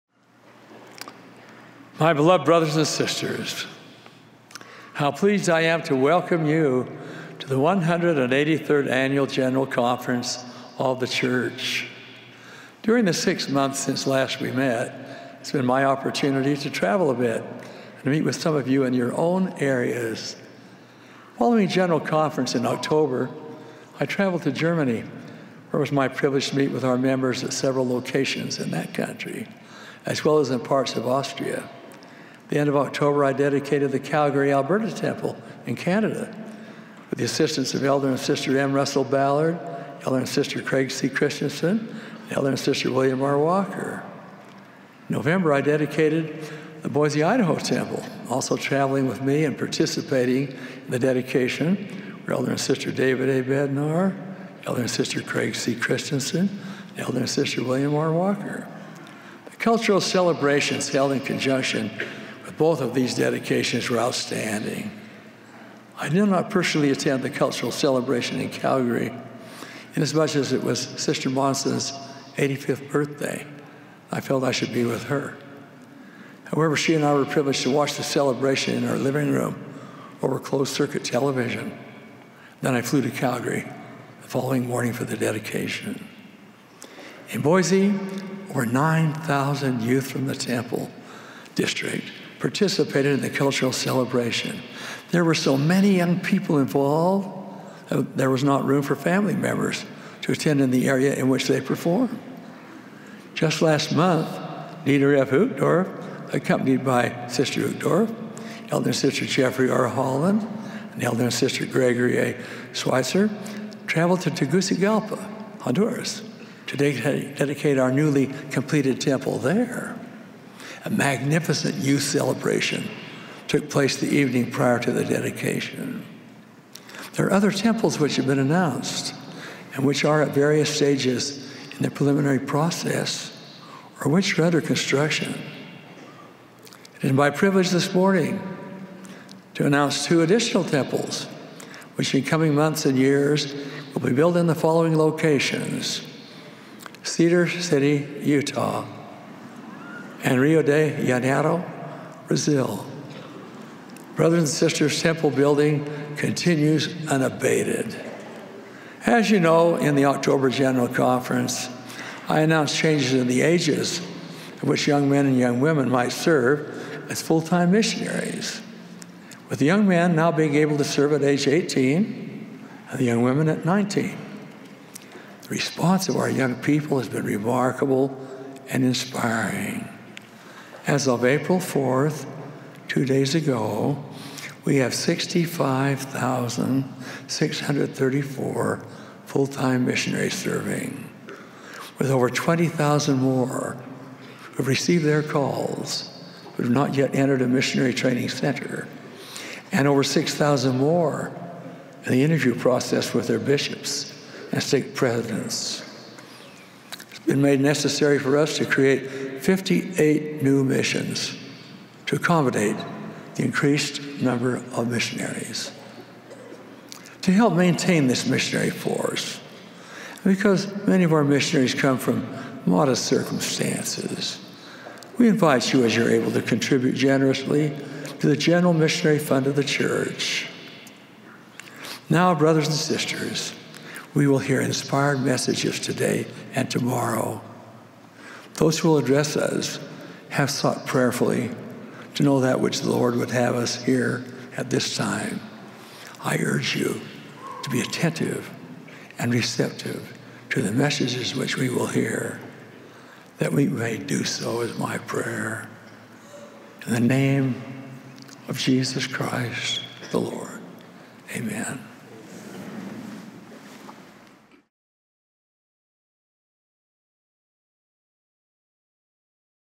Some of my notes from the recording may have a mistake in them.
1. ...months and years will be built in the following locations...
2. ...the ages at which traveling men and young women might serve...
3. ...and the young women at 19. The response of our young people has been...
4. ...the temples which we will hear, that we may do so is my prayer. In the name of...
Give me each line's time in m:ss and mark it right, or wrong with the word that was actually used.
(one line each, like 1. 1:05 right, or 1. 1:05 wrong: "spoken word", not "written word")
1. 2:22 right
2. 2:43 wrong: "young", not "traveling"
3. 2:52 right
4. 4:10 wrong: "messages", not "temples".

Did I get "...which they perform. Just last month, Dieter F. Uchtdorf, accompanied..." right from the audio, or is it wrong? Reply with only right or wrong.
right.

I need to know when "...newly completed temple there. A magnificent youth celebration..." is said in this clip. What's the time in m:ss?
1:57.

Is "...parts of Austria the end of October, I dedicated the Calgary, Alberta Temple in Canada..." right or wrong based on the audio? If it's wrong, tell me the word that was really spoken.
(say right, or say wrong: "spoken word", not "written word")
right.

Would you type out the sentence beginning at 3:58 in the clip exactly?
Those who will address us have sought prayerfully to know that which the Lord would have us hear at this time.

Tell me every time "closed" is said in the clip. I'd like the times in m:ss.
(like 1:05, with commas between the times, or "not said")
1:20.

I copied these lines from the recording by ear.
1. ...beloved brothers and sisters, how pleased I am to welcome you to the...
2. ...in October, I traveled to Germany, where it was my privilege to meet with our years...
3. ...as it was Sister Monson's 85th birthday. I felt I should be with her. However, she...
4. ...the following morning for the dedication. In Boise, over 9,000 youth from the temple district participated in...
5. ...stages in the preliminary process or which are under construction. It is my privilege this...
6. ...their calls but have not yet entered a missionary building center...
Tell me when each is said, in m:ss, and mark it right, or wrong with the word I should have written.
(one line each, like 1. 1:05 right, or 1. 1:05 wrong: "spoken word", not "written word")
1. 0:02 right
2. 0:22 wrong: "members", not "years"
3. 1:10 right
4. 1:24 right
5. 2:10 right
6. 3:15 wrong: "training", not "building".